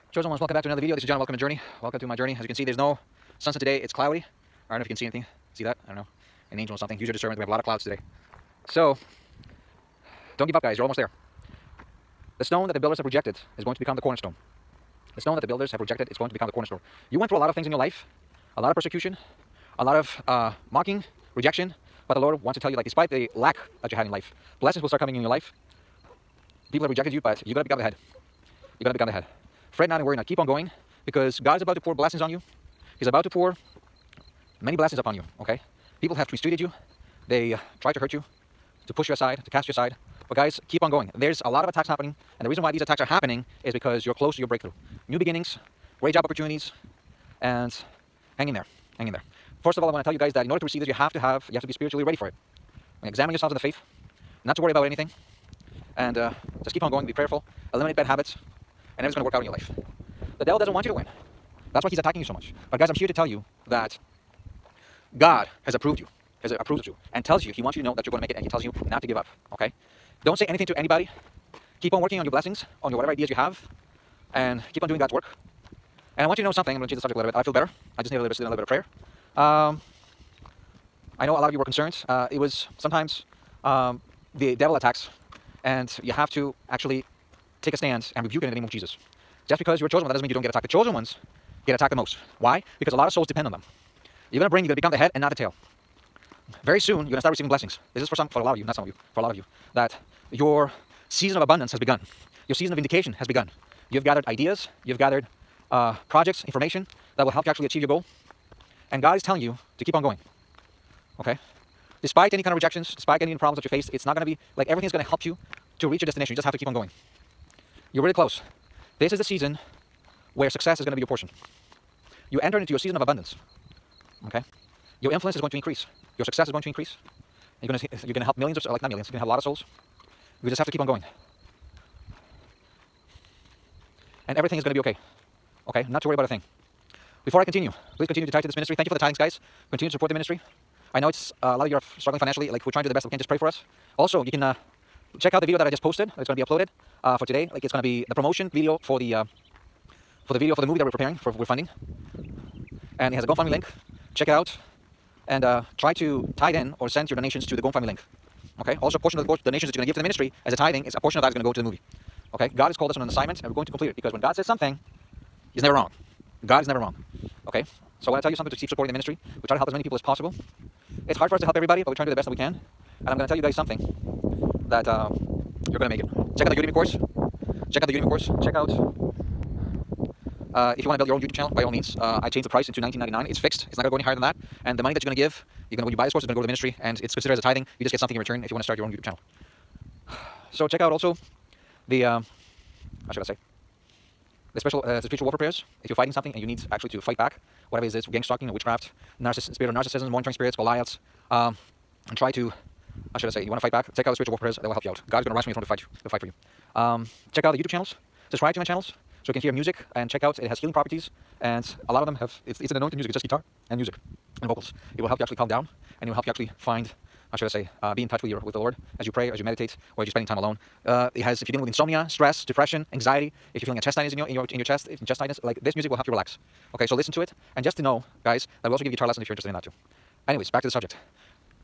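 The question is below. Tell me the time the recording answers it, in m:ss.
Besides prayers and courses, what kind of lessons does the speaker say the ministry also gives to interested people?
3:48.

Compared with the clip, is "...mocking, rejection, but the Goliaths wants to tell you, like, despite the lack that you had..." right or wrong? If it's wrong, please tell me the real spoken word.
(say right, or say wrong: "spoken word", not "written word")
wrong: "Lord", not "Goliaths".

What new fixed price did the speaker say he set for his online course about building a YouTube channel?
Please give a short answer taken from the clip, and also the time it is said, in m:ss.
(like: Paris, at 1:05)
$19.99, at 3:02.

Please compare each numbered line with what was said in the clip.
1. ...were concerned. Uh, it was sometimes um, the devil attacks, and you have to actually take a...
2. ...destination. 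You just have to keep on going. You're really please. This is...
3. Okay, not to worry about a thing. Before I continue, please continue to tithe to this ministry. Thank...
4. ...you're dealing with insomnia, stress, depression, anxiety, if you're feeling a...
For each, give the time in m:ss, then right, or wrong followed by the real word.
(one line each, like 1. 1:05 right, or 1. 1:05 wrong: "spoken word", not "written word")
1. 1:21 right
2. 1:56 wrong: "close", not "please"
3. 2:15 right
4. 3:41 right.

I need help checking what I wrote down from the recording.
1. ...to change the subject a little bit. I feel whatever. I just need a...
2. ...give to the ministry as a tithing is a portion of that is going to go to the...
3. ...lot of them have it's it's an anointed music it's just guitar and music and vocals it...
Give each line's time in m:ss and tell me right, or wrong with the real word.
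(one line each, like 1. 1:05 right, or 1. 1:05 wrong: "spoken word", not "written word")
1. 1:16 wrong: "better", not "whatever"
2. 2:39 right
3. 3:31 right.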